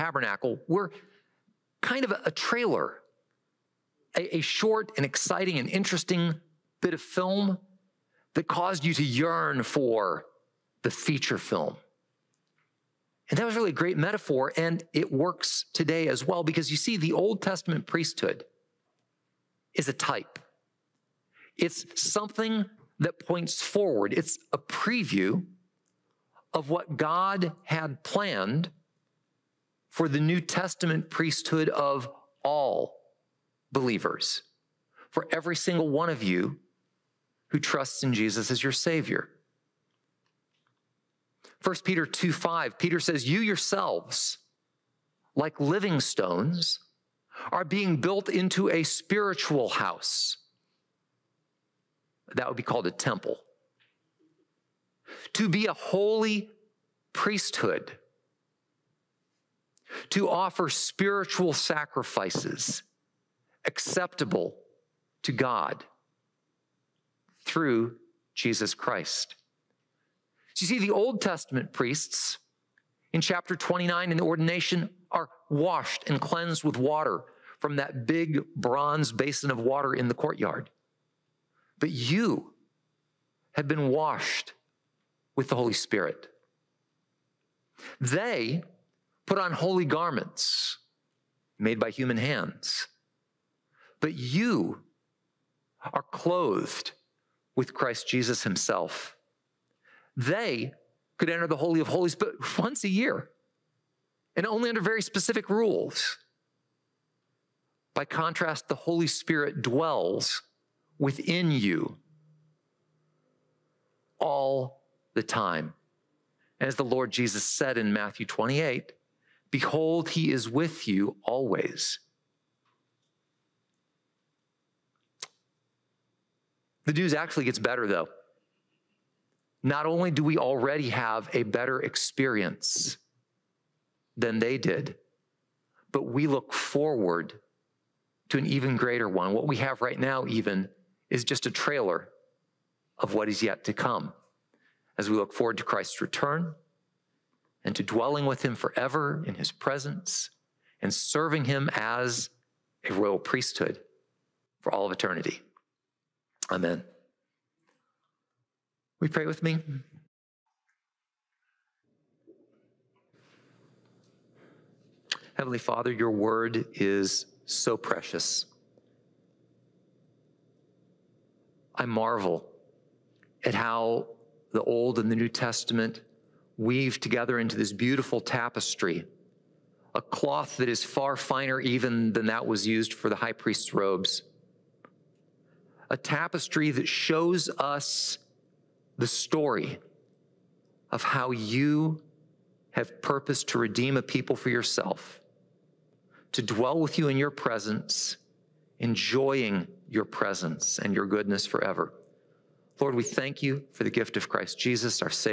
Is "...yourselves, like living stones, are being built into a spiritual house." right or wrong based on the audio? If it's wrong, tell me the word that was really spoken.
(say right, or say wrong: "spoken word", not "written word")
right.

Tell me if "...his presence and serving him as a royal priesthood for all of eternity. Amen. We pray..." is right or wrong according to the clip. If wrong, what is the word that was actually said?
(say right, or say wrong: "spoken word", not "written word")
right.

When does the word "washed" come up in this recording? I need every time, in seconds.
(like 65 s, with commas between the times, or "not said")
75 s, 83 s.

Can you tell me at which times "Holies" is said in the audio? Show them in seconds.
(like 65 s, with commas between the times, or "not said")
101 s.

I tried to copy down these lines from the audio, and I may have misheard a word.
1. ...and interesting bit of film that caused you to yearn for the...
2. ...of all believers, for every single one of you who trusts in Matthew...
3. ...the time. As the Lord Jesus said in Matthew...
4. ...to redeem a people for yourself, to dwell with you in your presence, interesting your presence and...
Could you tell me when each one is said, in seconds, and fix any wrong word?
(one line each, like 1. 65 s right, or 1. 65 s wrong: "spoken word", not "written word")
1. 5 s right
2. 31 s wrong: "Jesus", not "Matthew"
3. 115 s right
4. 193 s wrong: "enjoying", not "interesting".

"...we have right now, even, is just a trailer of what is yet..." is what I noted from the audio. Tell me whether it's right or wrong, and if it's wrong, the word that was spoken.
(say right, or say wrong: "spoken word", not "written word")
right.